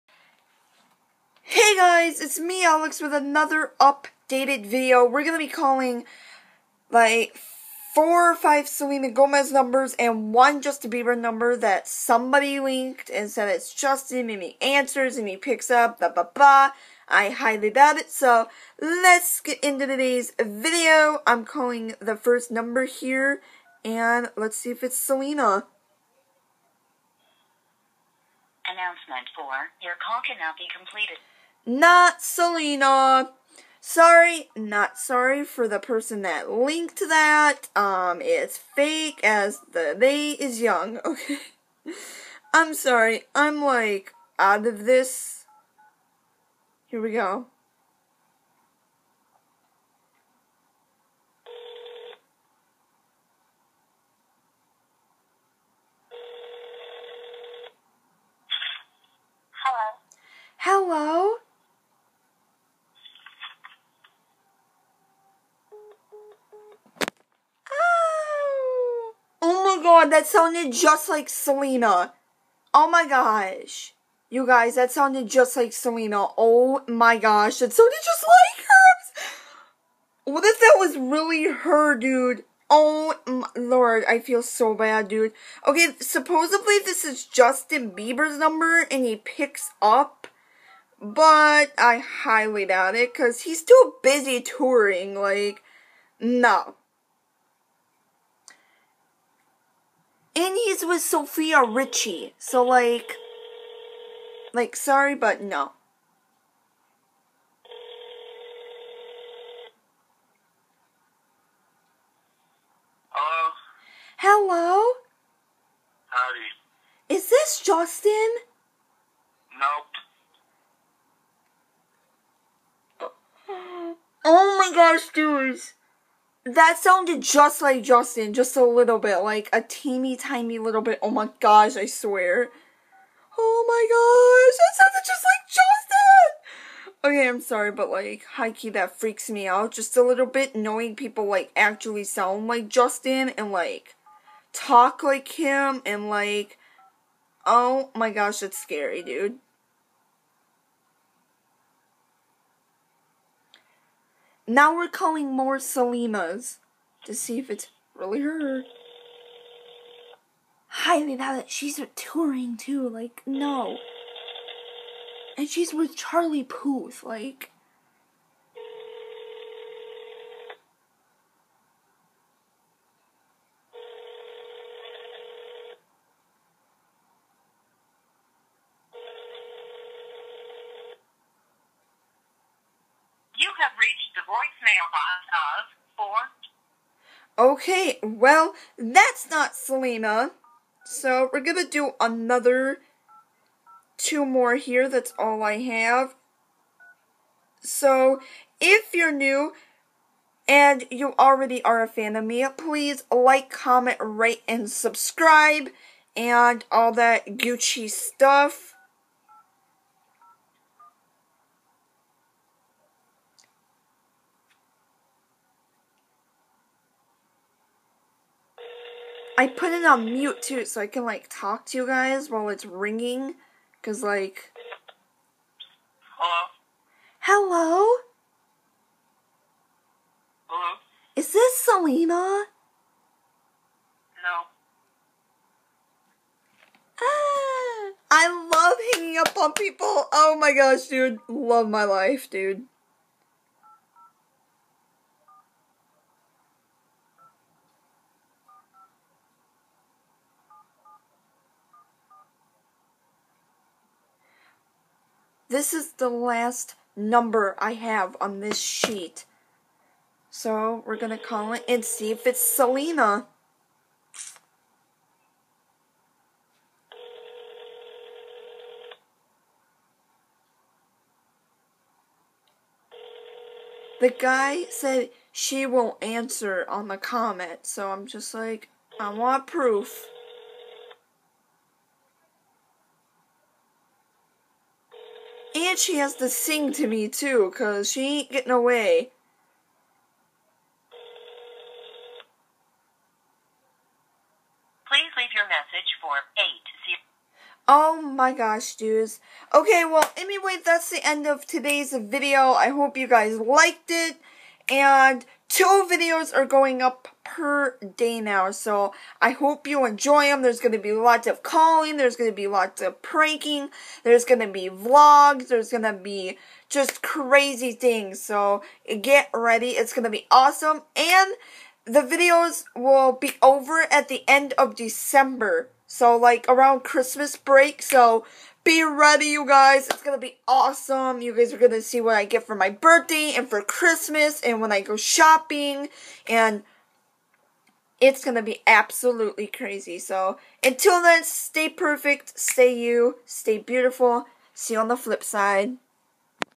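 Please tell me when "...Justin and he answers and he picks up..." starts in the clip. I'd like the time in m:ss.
0:13.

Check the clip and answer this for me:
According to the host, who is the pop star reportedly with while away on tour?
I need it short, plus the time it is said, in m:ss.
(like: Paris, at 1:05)
Sofia Richie, at 1:41.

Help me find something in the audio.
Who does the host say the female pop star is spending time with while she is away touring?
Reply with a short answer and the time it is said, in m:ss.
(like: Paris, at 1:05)
Charlie Puth, at 2:45.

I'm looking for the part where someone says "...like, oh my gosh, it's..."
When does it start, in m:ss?
2:26.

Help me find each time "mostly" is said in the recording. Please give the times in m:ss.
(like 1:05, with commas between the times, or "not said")
not said.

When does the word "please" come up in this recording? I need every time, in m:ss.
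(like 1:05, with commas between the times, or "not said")
3:22, 4:54.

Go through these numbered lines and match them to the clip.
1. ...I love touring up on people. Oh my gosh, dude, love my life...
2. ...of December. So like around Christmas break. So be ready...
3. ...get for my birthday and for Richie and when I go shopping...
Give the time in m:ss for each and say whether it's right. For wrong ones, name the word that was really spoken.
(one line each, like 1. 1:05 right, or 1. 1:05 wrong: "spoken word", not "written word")
1. 3:58 wrong: "hanging", not "touring"
2. 5:24 right
3. 5:32 wrong: "Christmas", not "Richie".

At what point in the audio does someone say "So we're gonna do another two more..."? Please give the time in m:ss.
3:10.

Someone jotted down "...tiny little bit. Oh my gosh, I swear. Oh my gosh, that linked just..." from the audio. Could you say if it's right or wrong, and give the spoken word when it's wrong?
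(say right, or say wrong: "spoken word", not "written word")
wrong: "sounded", not "linked".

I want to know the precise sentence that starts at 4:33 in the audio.
The guy said she won't answer on the comment, so I'm just like, I want proof.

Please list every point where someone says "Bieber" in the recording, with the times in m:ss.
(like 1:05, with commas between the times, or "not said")
0:10, 1:27.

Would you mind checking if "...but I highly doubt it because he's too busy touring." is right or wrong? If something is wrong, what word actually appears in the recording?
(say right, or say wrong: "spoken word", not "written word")
right.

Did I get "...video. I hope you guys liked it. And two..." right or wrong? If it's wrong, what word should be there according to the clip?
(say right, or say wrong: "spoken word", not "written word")
right.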